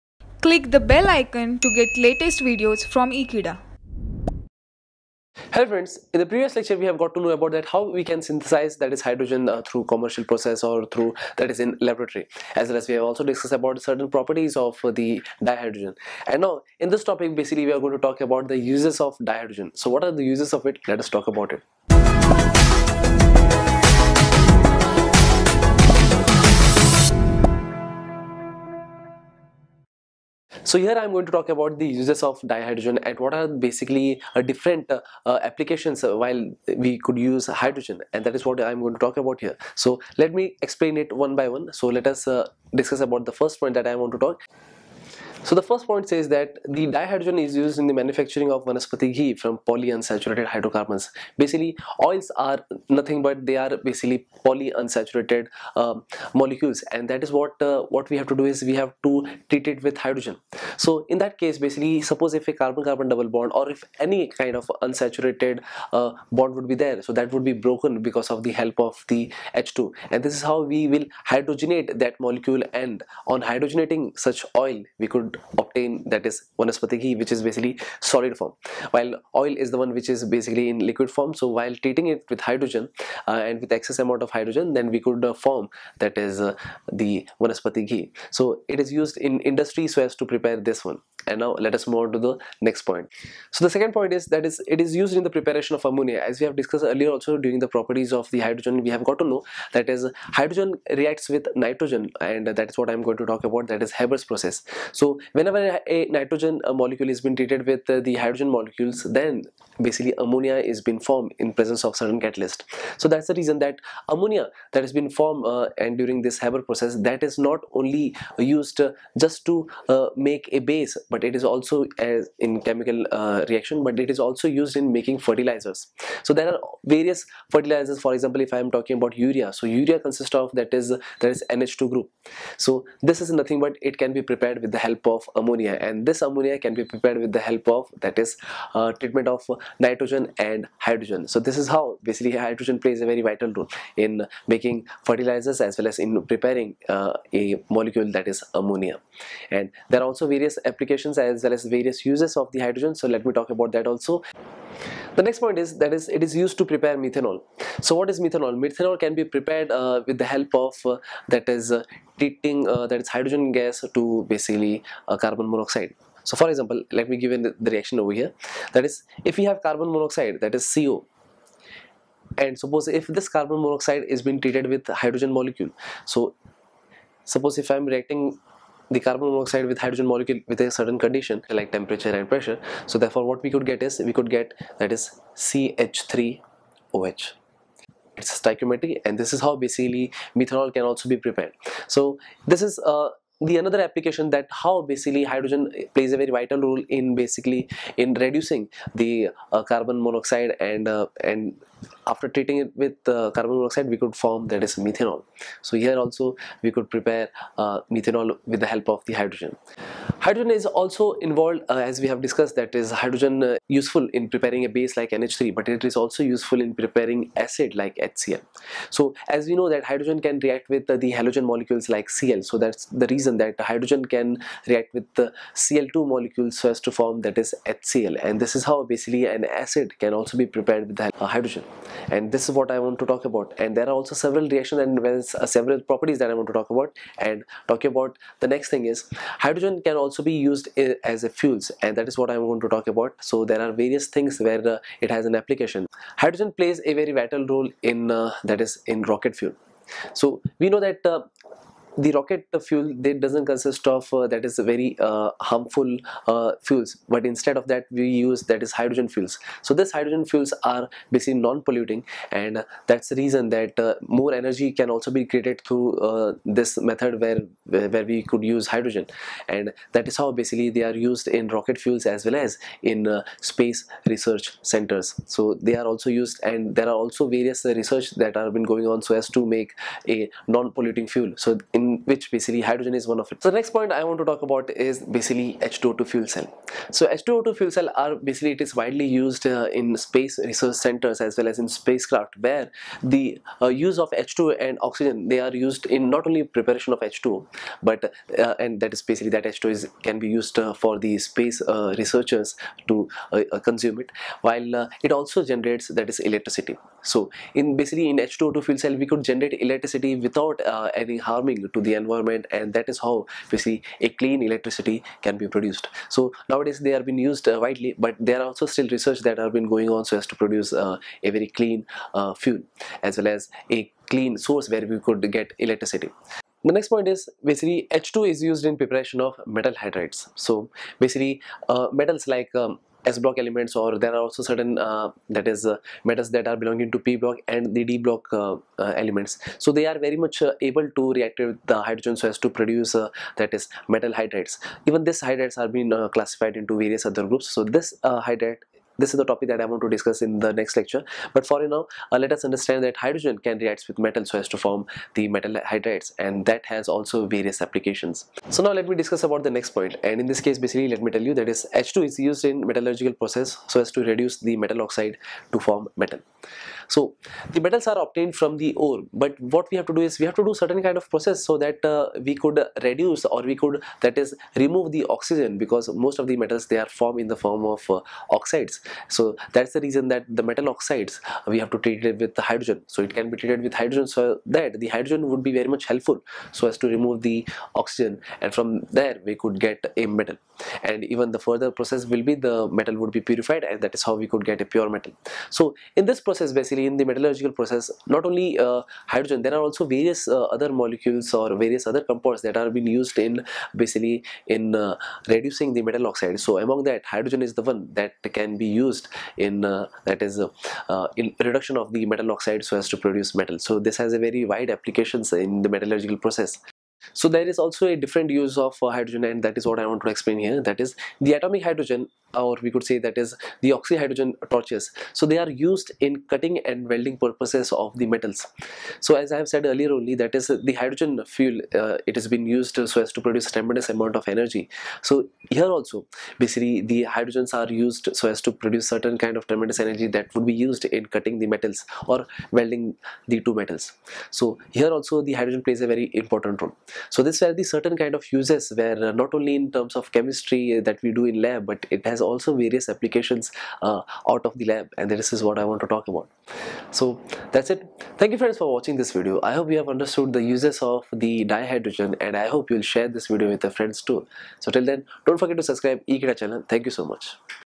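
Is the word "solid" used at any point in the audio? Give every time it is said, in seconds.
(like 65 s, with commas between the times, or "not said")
78 s.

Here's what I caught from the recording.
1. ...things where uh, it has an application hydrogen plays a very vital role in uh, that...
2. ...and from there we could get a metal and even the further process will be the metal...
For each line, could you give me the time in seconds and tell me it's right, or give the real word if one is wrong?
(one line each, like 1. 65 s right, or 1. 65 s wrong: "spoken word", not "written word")
1. 244 s right
2. 388 s right.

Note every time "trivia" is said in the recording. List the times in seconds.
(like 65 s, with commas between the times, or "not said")
not said.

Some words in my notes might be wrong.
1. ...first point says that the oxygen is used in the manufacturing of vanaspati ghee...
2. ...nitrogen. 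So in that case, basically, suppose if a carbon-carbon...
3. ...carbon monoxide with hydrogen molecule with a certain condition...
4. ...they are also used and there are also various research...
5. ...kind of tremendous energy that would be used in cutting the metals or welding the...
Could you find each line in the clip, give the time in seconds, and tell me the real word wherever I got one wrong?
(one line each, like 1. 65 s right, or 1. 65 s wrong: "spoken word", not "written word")
1. 45 s wrong: "dihydrogen", not "oxygen"
2. 59 s wrong: "hydrogen", not "nitrogen"
3. 178 s right
4. 275 s right
5. 439 s right.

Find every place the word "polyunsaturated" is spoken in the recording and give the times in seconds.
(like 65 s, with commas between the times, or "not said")
49 s, 54 s.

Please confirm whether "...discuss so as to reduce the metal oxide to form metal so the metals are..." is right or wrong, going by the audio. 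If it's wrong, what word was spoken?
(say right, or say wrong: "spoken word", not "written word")
wrong: "process", not "discuss".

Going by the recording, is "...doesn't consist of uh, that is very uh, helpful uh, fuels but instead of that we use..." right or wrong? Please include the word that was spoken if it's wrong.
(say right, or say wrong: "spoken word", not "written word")
wrong: "harmful", not "helpful".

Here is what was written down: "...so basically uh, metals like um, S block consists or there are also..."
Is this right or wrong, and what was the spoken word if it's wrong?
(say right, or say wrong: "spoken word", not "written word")
wrong: "elements", not "consists".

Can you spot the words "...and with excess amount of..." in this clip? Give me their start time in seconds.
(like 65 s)
83 s.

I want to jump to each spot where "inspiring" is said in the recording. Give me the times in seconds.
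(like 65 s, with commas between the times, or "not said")
not said.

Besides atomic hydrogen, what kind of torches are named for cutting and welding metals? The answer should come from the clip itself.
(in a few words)
oxyhydrogen torches.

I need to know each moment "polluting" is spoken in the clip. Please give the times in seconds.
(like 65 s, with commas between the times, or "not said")
261 s, 280 s.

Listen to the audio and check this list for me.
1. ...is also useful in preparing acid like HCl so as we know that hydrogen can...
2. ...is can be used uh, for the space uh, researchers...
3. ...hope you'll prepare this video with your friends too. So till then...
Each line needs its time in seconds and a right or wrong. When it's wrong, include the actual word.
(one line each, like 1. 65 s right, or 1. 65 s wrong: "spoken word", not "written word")
1. 215 s right
2. 299 s right
3. 462 s wrong: "share", not "prepare".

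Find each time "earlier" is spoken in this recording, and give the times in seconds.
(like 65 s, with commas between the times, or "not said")
96 s, 429 s.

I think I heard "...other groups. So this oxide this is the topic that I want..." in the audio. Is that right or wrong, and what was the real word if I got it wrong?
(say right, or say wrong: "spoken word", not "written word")
wrong: "hydride", not "oxide".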